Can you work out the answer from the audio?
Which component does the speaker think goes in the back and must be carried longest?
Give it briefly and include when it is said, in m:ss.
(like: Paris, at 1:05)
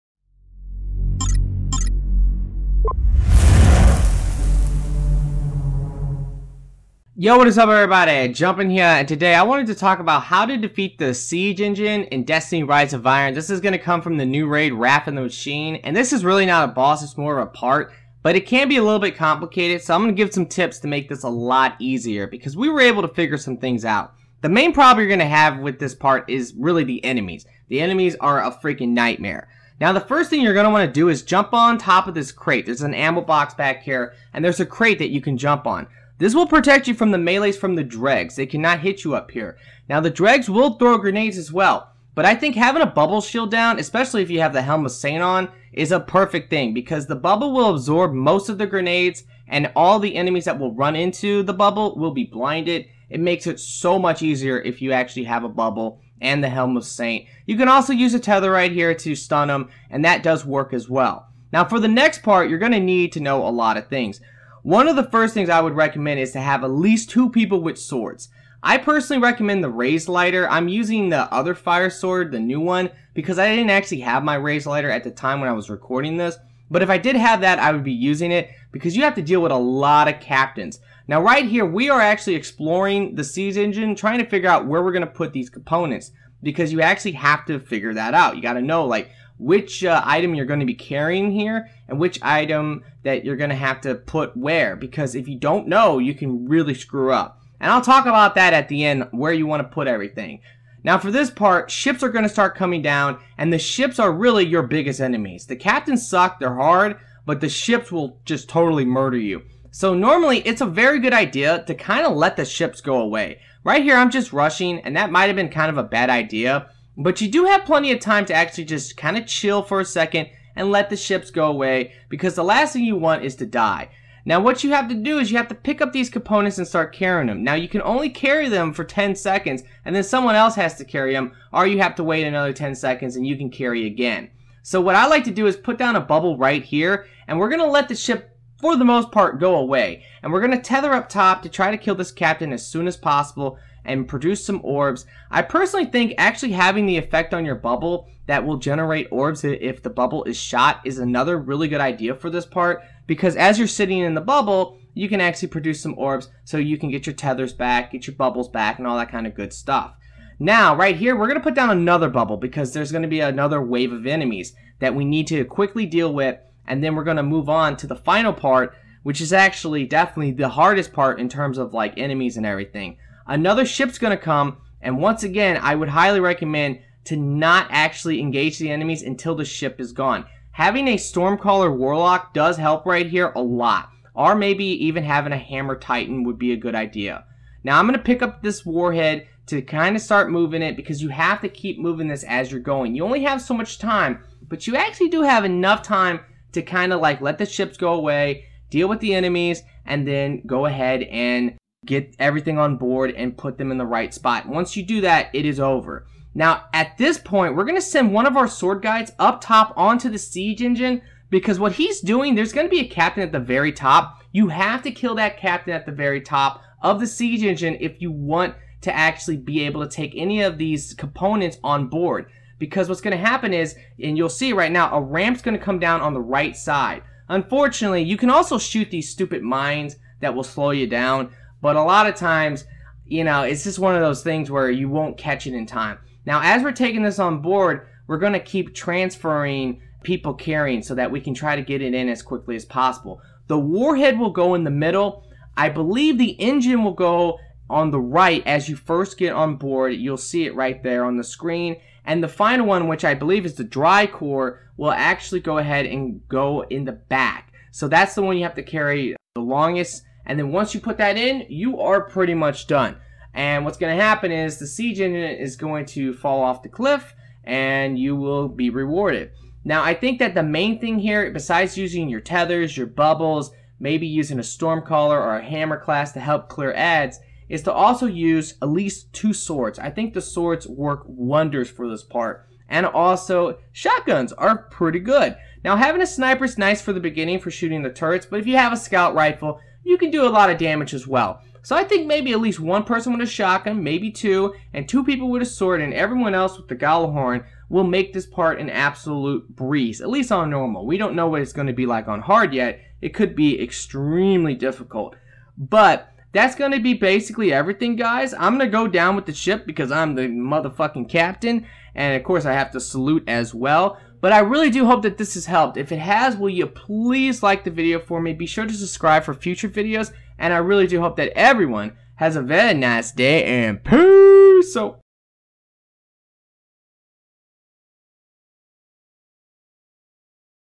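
Dry core, at 4:13.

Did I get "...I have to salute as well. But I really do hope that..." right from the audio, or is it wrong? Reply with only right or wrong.
right.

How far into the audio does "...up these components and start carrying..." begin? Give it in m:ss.
2:05.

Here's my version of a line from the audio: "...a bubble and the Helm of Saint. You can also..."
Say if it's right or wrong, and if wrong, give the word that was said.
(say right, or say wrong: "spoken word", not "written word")
right.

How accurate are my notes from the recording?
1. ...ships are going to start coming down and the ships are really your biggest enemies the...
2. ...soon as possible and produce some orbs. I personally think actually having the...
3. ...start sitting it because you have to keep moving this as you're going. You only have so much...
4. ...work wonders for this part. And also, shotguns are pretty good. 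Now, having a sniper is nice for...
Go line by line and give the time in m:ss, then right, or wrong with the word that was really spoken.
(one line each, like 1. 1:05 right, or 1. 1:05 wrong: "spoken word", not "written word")
1. 1:41 right
2. 2:22 right
3. 3:10 wrong: "moving", not "sitting"
4. 4:40 right.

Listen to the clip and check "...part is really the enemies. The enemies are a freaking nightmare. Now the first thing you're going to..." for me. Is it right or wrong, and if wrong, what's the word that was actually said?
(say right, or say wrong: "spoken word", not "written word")
right.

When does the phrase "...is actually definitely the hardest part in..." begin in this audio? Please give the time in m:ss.
2:49.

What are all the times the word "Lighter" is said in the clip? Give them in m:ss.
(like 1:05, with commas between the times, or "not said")
1:09, 1:14.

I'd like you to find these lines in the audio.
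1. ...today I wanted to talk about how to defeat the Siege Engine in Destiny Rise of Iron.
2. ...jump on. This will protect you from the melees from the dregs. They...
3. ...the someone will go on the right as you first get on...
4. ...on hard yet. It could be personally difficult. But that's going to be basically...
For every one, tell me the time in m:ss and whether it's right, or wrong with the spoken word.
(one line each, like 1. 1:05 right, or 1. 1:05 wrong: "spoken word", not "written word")
1. 0:09 right
2. 0:35 right
3. 4:06 wrong: "engine", not "someone"
4. 5:02 wrong: "extremely", not "personally".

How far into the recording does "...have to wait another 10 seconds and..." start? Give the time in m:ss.
2:11.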